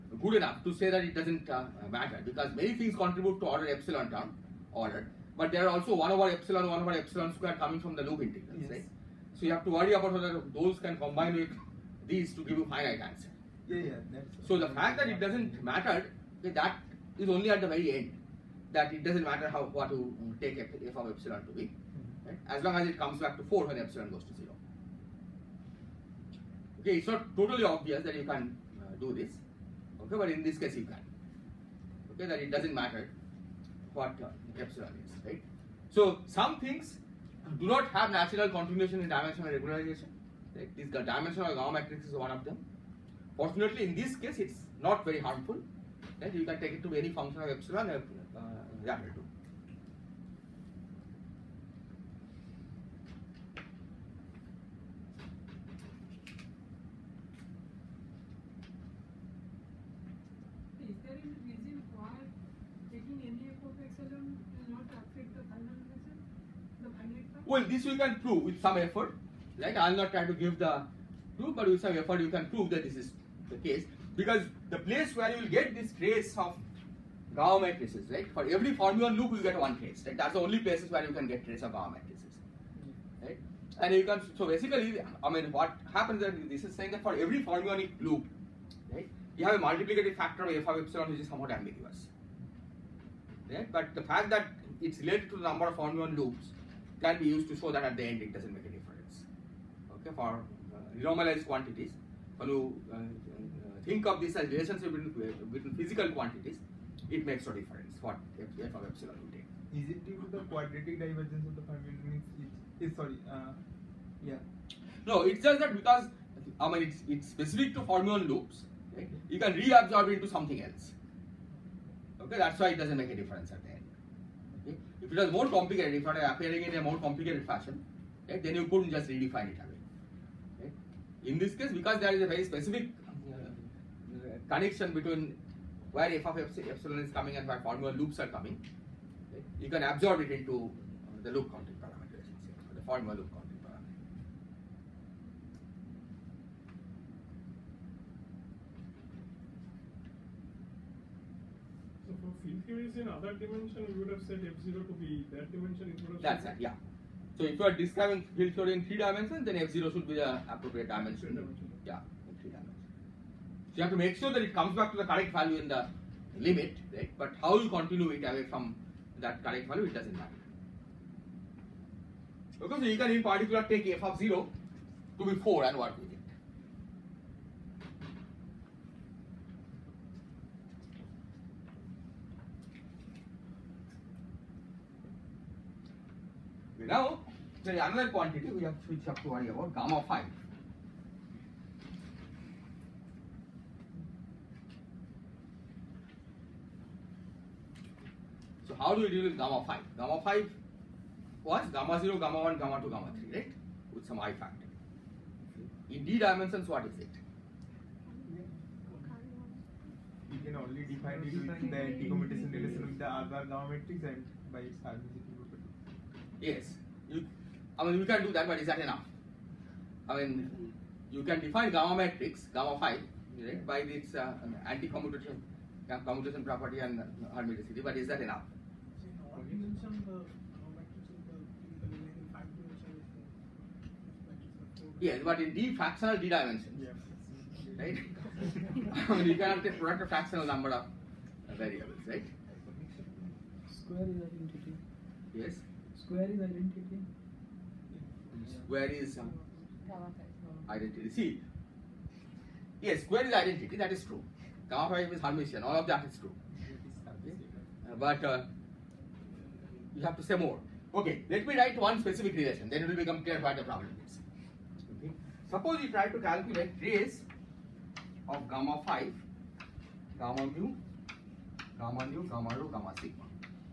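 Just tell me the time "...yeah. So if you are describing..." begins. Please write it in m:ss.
2:36.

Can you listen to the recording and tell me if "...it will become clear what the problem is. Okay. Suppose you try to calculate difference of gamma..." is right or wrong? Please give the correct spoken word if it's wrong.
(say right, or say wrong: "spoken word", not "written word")
wrong: "trace", not "difference".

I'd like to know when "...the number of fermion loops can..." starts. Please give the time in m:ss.
1:35.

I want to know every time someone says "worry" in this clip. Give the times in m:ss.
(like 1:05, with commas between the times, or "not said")
0:09, 3:09.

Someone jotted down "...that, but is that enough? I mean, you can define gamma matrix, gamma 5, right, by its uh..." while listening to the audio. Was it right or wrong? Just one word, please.
right.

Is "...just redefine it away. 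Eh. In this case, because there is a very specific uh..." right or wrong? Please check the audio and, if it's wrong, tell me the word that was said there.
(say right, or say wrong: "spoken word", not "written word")
right.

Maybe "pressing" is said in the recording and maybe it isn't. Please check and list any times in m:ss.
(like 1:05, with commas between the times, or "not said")
not said.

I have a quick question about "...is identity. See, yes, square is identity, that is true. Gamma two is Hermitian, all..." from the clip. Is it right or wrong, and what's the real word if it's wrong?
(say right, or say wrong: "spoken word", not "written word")
wrong: "five", not "two".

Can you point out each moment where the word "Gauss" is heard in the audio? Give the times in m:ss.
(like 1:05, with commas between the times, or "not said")
1:17, 1:21.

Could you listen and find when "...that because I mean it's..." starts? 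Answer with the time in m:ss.
1:55.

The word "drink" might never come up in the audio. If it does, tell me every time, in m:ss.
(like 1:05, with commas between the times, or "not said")
not said.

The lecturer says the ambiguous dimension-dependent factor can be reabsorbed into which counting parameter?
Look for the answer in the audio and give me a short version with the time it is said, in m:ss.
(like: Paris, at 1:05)
Loop counting parameter, at 2:21.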